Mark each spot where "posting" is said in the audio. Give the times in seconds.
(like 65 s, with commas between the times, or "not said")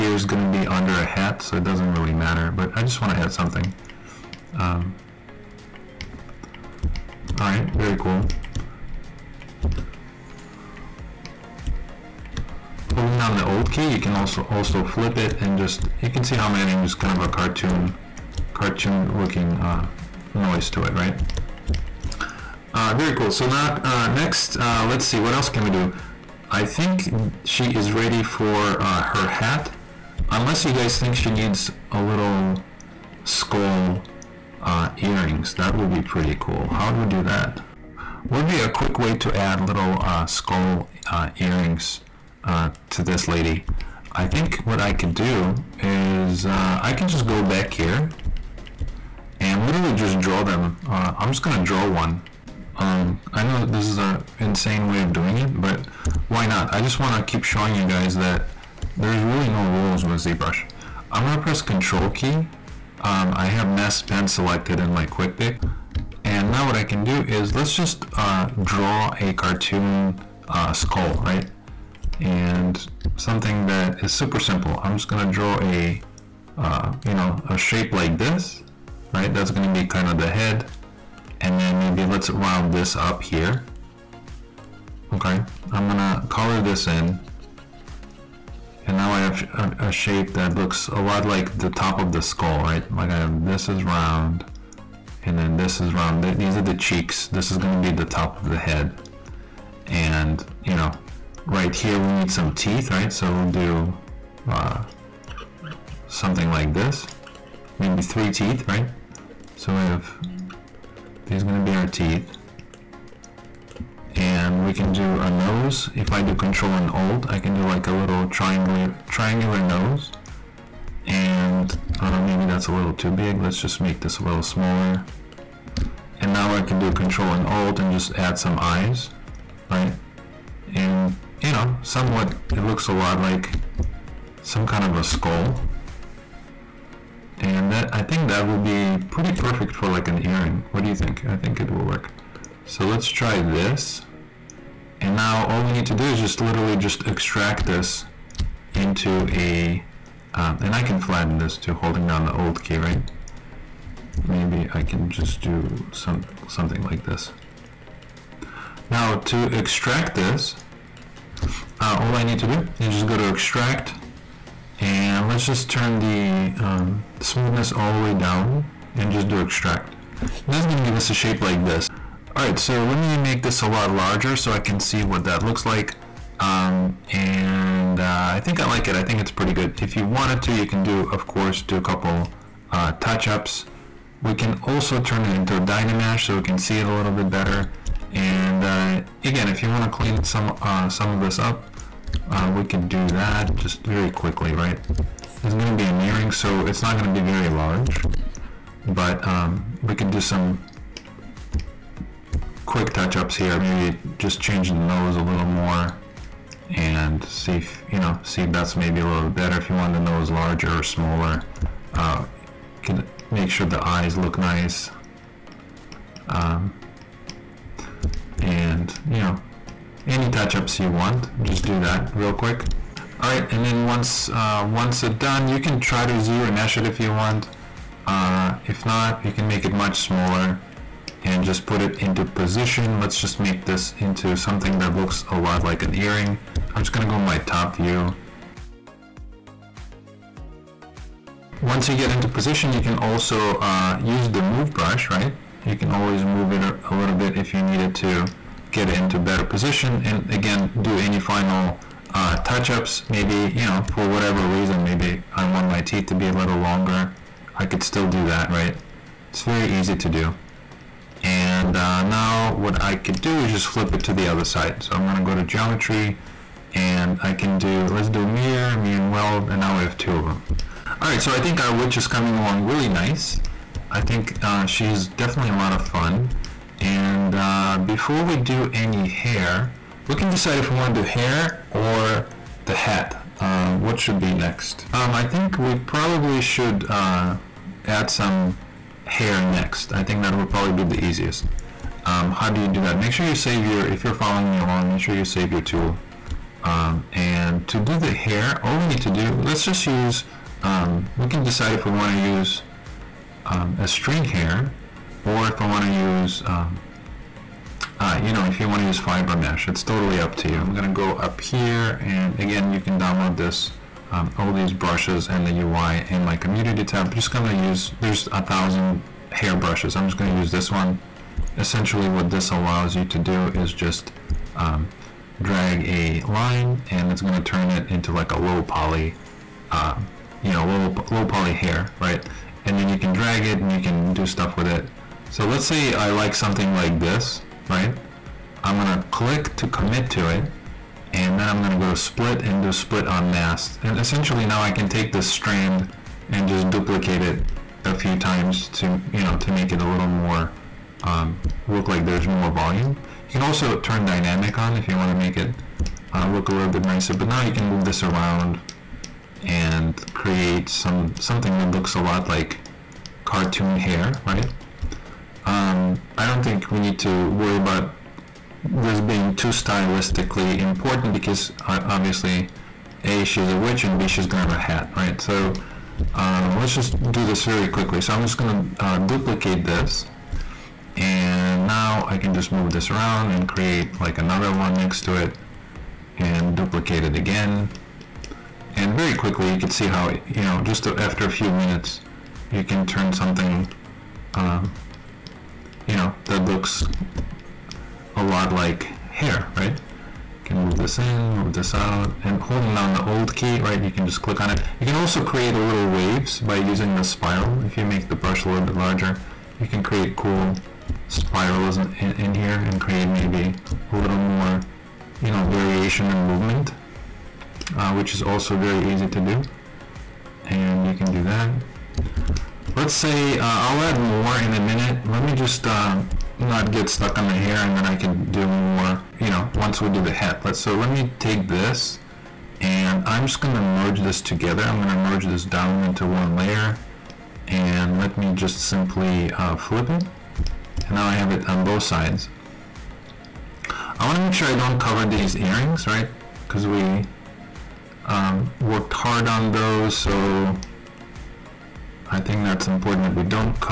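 not said.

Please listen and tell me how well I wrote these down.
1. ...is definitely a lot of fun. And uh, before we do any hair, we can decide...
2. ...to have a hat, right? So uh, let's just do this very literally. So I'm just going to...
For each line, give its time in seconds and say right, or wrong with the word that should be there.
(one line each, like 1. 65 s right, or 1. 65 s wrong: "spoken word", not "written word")
1. 274 s right
2. 374 s wrong: "quickly", not "literally".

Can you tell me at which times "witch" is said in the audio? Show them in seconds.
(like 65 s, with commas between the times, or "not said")
271 s, 373 s.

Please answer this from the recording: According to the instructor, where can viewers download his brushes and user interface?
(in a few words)
community tab.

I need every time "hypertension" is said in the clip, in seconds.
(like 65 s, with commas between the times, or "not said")
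not said.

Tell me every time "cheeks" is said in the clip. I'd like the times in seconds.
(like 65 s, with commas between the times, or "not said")
96 s.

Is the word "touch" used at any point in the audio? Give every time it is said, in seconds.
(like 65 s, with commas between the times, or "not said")
182 s, 202 s, 220 s, 252 s.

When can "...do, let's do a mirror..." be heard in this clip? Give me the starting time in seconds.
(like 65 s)
267 s.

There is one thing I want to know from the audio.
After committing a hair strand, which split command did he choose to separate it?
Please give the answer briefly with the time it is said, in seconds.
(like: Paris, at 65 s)
split on mask, at 342 s.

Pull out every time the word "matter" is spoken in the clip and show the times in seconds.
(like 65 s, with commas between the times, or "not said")
2 s.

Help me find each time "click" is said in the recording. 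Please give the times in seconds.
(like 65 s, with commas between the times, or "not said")
339 s, 404 s.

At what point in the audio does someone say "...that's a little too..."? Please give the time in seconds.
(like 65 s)
122 s.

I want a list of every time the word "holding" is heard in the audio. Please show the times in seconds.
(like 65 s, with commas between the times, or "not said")
12 s, 151 s, 402 s.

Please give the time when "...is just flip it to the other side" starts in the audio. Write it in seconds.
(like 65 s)
263 s.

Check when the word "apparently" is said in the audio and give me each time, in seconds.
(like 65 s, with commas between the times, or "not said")
not said.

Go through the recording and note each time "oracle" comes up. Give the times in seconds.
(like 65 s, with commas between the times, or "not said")
not said.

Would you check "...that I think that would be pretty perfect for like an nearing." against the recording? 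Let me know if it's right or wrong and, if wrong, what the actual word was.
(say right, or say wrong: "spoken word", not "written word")
wrong: "earring", not "nearing".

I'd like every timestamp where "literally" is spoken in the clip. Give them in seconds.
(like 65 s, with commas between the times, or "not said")
49 s, 146 s.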